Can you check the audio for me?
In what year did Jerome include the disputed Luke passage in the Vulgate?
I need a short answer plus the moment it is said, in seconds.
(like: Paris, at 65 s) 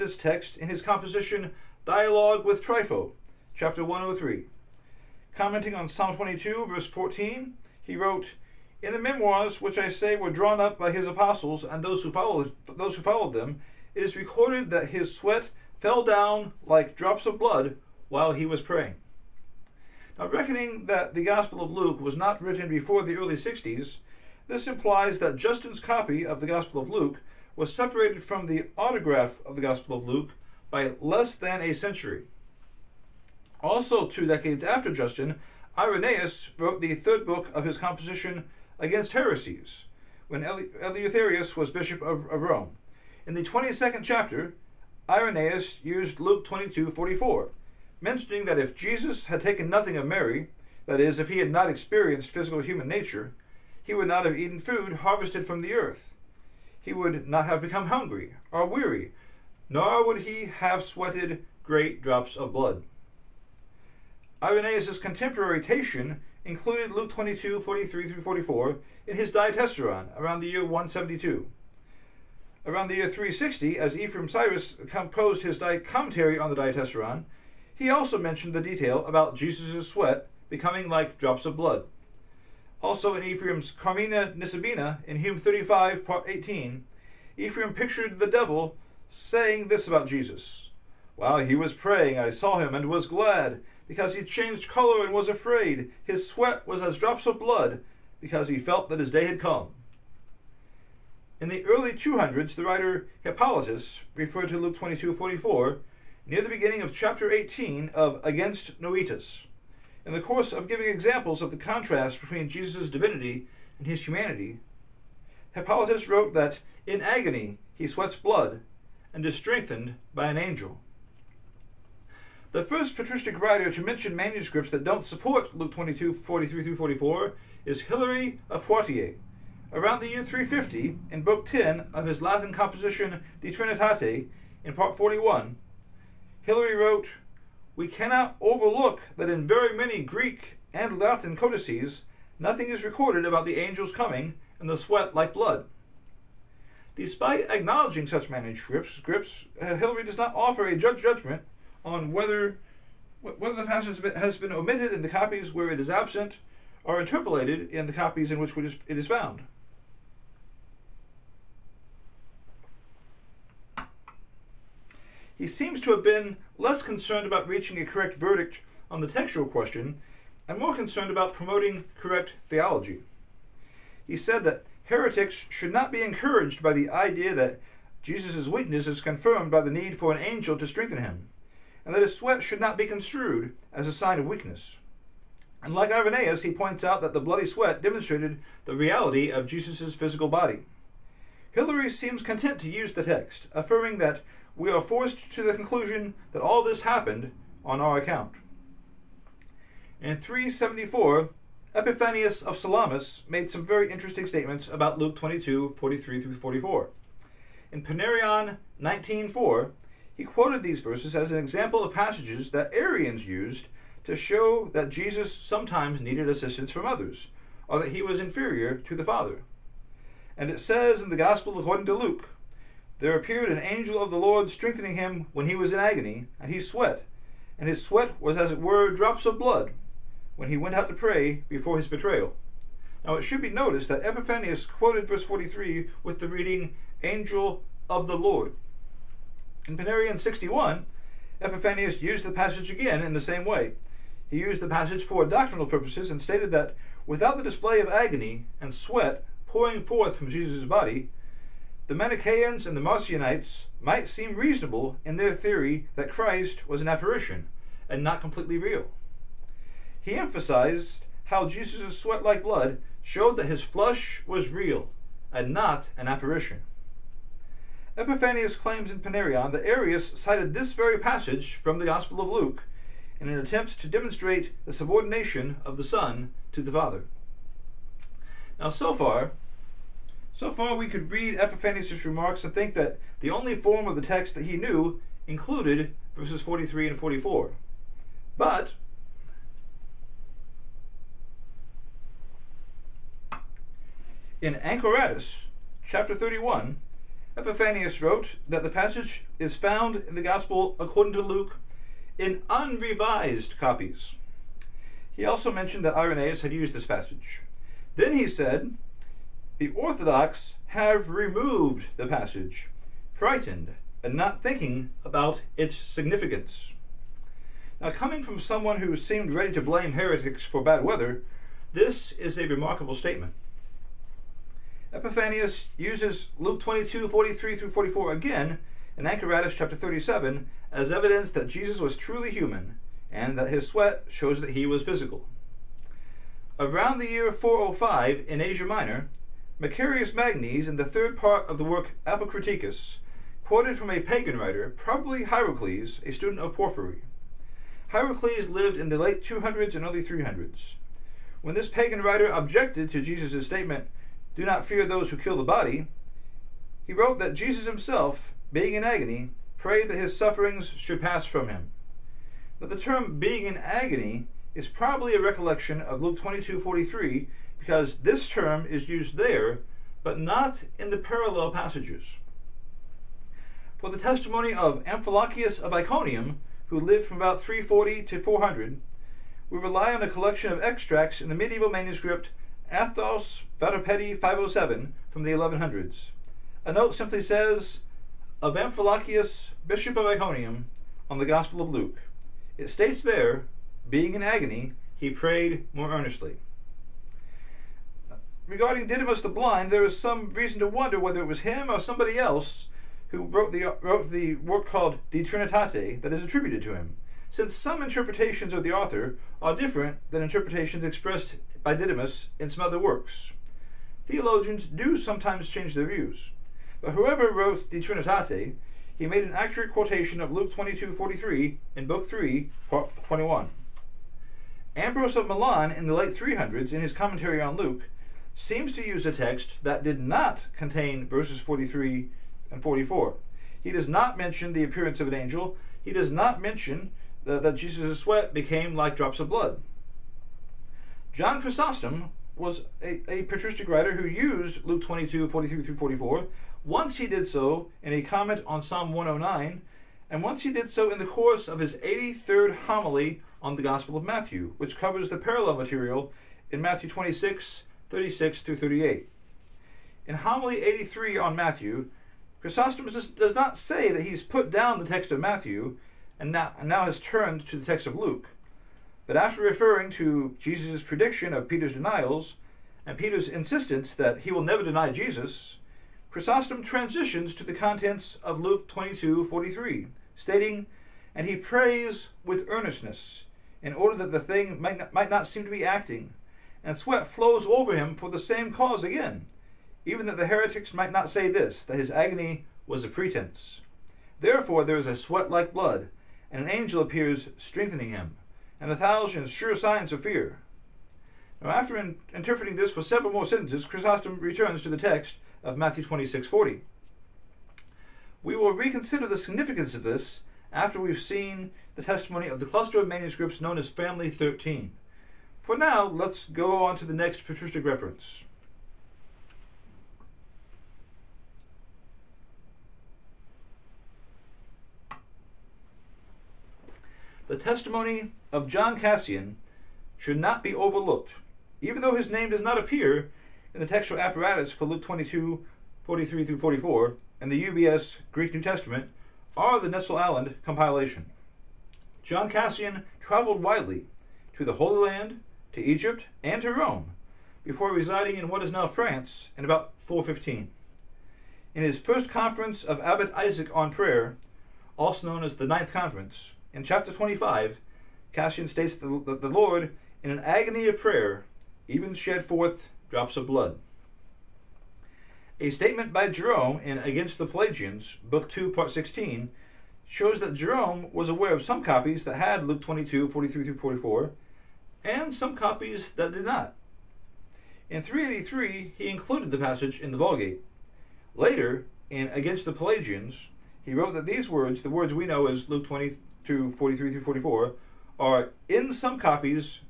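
383, at 577 s.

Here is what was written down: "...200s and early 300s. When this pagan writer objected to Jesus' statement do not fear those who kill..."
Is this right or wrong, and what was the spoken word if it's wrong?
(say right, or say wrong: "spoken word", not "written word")
right.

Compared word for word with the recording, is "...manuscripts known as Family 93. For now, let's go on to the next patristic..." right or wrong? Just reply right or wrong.
wrong.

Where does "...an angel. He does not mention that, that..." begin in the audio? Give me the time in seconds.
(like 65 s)
435 s.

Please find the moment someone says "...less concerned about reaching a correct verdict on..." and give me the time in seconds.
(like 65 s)
166 s.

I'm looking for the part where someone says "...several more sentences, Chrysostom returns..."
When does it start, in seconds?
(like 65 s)
502 s.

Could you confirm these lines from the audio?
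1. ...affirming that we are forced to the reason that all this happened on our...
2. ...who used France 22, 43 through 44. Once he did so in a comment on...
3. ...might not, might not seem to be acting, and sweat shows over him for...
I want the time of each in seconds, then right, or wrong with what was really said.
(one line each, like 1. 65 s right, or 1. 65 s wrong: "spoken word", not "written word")
1. 193 s wrong: "conclusion", not "reason"
2. 443 s wrong: "Luke", not "France"
3. 484 s wrong: "flows", not "shows".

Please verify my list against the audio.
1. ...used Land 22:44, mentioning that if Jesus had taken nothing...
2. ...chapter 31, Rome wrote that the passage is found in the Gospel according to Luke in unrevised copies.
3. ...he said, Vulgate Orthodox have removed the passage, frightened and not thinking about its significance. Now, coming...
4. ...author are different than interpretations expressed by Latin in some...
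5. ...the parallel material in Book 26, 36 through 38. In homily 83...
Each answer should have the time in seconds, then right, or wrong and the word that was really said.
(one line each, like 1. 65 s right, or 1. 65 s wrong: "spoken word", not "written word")
1. 45 s wrong: "Luke", not "Land"
2. 295 s wrong: "Epiphanius", not "Rome"
3. 308 s wrong: "The", not "Vulgate"
4. 408 s wrong: "Didymus", not "Latin"
5. 455 s wrong: "Matthew", not "Book".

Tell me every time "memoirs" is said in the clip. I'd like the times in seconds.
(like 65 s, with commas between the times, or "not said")
8 s.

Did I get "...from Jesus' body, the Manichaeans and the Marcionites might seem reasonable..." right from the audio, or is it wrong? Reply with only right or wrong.
right.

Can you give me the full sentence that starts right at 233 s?
Now it should be noticed that Epiphanius quoted verse 43 with the reading, Angel of the Lord.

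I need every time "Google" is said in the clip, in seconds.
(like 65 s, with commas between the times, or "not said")
not said.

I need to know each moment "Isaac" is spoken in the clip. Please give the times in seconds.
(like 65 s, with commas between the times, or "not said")
553 s.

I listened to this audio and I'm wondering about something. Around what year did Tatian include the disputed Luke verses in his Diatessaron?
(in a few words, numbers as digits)
172.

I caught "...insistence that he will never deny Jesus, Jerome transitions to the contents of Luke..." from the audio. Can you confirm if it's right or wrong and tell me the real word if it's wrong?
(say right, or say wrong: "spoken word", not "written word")
wrong: "Chrysostom", not "Jerome".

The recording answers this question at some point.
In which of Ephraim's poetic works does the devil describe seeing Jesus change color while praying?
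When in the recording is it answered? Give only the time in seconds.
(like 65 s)
83 s.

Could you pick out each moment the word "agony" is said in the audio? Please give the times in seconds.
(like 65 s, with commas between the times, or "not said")
117 s, 225 s, 247 s, 358 s, 363 s, 394 s, 491 s, 560 s.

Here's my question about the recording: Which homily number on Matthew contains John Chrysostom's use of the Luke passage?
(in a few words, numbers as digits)
83rd.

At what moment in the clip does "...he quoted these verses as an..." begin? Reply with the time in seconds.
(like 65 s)
210 s.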